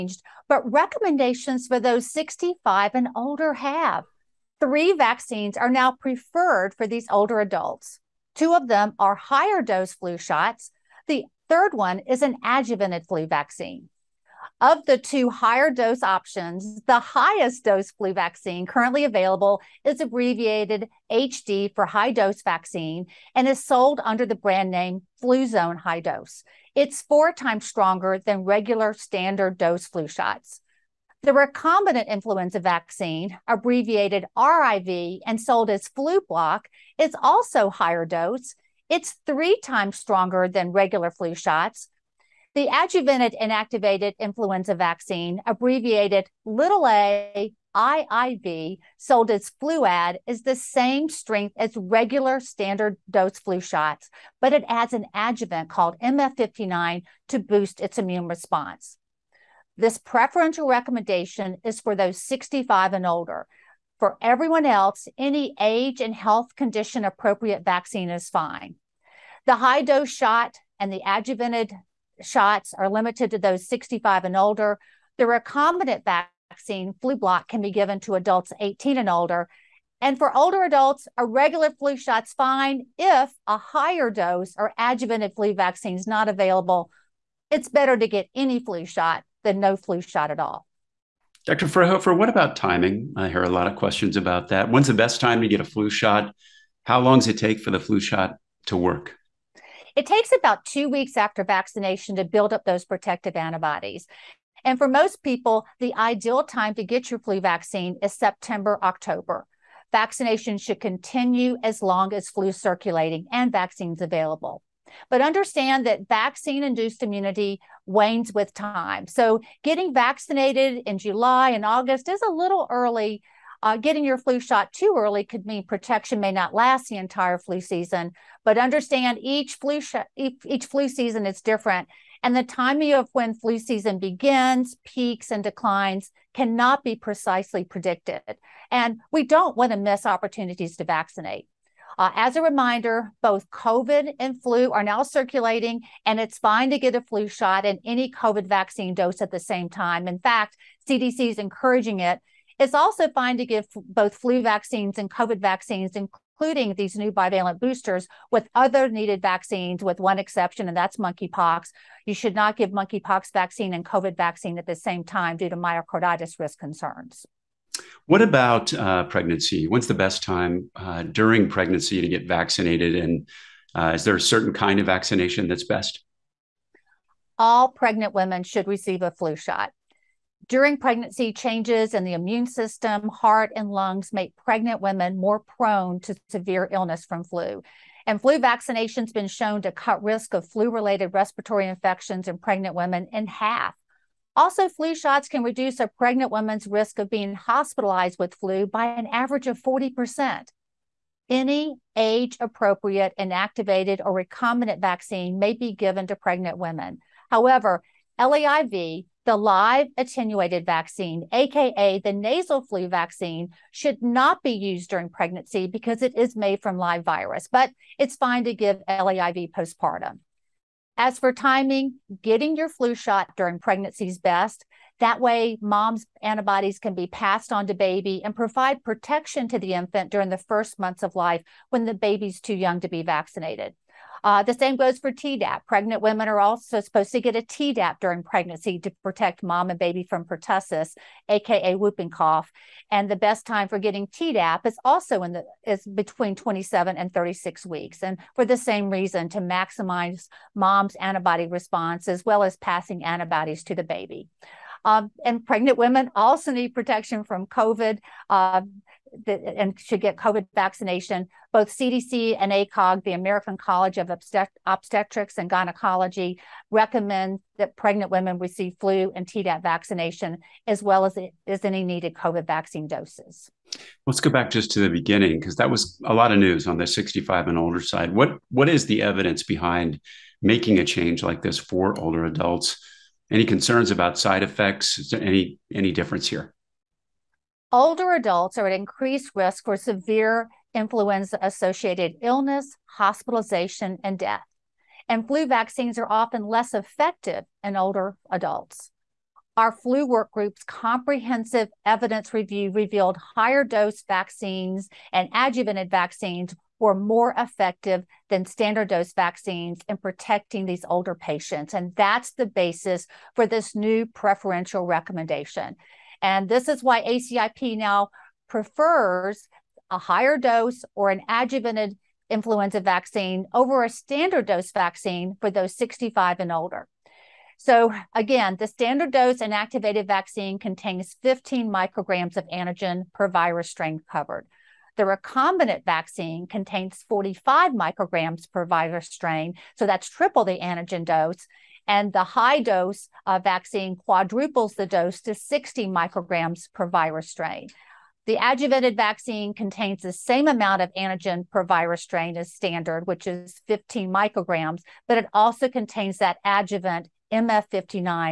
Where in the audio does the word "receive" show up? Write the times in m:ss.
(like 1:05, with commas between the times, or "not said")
2:58, 4:28.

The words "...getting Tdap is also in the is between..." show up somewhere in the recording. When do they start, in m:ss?
4:03.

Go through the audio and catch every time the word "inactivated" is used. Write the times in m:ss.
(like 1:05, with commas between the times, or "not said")
0:43, 3:23, 5:29.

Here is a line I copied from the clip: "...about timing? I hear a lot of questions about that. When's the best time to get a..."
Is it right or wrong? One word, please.
right.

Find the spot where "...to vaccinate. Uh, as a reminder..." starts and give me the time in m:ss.
2:20.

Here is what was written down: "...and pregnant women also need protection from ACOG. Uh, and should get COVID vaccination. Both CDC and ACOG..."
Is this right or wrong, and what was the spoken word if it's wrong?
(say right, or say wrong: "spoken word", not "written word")
wrong: "COVID", not "ACOG".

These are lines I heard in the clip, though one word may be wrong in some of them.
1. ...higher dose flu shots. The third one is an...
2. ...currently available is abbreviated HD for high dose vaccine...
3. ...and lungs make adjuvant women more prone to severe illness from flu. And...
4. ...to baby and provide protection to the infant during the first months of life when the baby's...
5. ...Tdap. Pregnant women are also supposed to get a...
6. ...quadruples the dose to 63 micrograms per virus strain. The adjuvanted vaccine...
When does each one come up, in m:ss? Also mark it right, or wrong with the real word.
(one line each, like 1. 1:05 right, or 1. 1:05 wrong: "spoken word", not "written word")
1. 0:09 right
2. 0:18 right
3. 3:03 wrong: "pregnant", not "adjuvant"
4. 3:47 right
5. 3:55 right
6. 5:43 wrong: "60", not "63".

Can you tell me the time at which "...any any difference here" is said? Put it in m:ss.
4:45.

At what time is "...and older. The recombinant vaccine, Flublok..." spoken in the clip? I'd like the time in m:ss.
1:14.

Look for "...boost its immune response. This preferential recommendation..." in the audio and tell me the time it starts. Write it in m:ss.
0:57.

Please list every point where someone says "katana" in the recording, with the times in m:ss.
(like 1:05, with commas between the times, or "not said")
not said.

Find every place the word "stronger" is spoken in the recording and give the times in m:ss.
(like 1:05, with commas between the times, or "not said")
0:27, 0:39.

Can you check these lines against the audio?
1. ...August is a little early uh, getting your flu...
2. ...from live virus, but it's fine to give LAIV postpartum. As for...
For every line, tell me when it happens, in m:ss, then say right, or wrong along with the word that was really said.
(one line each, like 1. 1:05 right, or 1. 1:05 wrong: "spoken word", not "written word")
1. 2:01 right
2. 3:36 right.